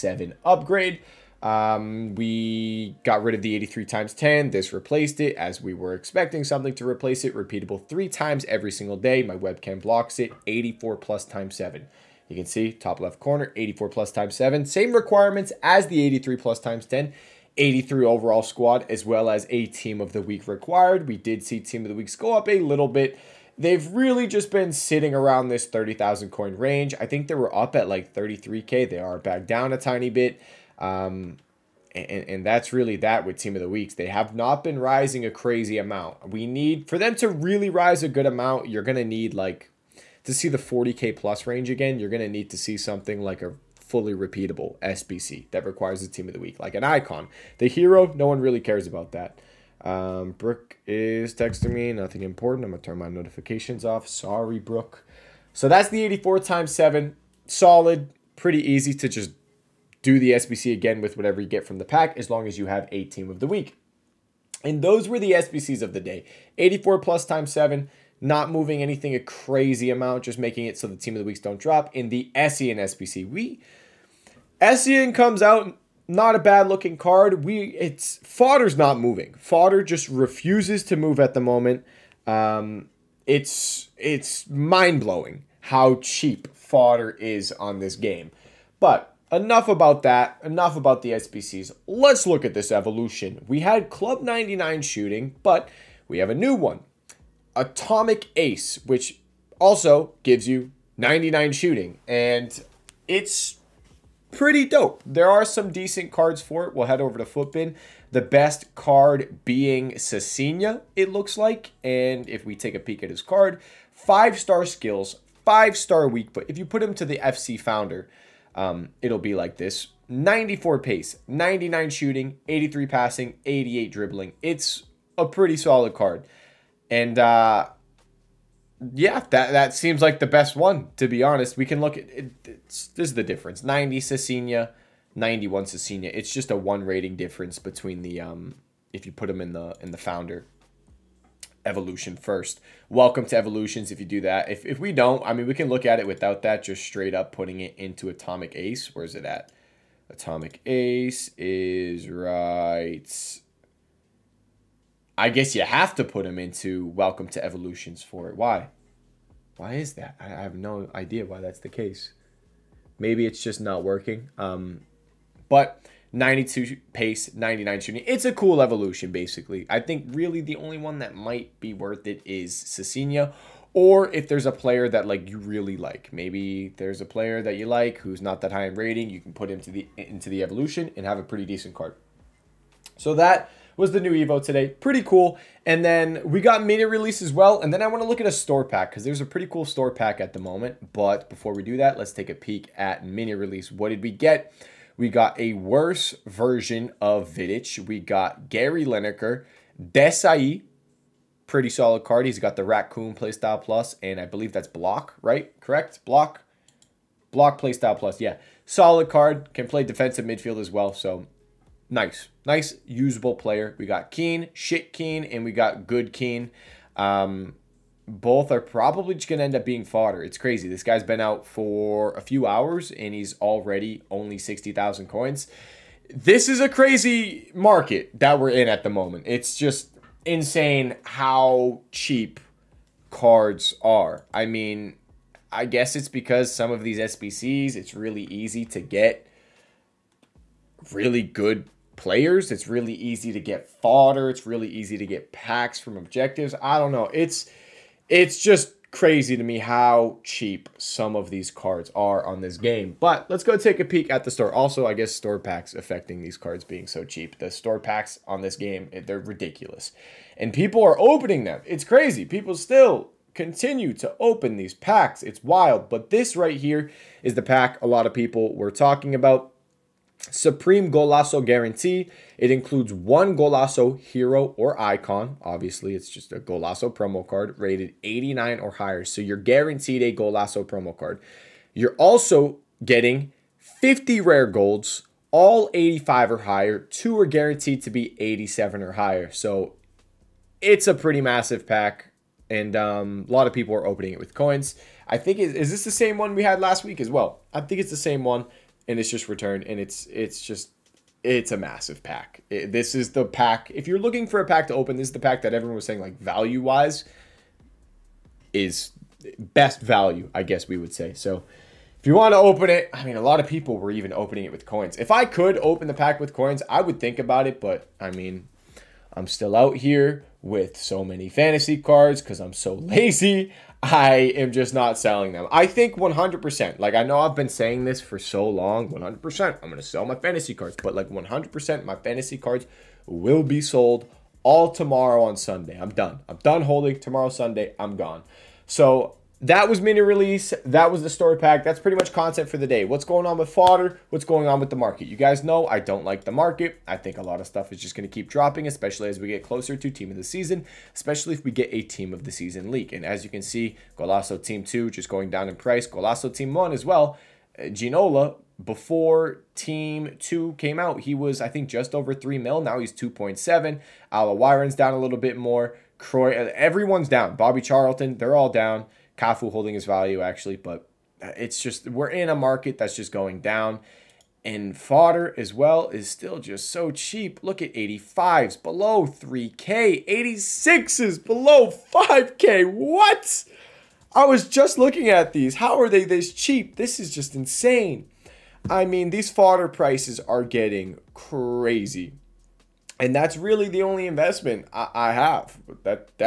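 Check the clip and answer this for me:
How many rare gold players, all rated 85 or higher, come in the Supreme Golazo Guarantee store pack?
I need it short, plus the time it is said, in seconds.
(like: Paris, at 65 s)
50, at 283 s.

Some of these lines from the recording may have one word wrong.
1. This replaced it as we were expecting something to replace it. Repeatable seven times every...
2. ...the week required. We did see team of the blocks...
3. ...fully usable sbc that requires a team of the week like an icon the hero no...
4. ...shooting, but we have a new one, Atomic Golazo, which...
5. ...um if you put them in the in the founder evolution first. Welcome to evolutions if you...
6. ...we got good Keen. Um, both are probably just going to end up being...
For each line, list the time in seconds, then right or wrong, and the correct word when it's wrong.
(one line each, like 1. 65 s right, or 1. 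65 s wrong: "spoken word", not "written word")
1. 4 s wrong: "three", not "seven"
2. 20 s wrong: "weeks", not "blocks"
3. 43 s wrong: "repeatable", not "usable"
4. 94 s wrong: "Ace", not "Golazo"
5. 138 s right
6. 215 s right.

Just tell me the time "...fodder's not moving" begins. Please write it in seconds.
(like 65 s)
78 s.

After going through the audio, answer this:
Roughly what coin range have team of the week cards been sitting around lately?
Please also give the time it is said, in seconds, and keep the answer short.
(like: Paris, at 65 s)
30,000 coins, at 25 s.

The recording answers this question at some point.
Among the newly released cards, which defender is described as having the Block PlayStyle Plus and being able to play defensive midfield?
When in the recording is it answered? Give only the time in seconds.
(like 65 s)
199 s.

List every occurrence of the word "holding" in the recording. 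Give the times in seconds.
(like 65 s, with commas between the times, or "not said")
336 s, 369 s.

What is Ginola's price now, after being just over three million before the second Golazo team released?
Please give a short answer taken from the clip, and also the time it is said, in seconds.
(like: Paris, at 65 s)
2.7 million, at 362 s.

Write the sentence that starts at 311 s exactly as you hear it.
So if you want to open it, I mean, a lot of people were even opening it with coins.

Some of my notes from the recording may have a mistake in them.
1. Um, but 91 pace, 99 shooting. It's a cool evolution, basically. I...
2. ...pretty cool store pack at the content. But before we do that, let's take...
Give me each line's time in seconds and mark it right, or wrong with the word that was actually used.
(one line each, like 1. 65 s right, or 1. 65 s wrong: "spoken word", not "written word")
1. 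164 s wrong: "92", not "91"
2. 189 s wrong: "moment", not "content".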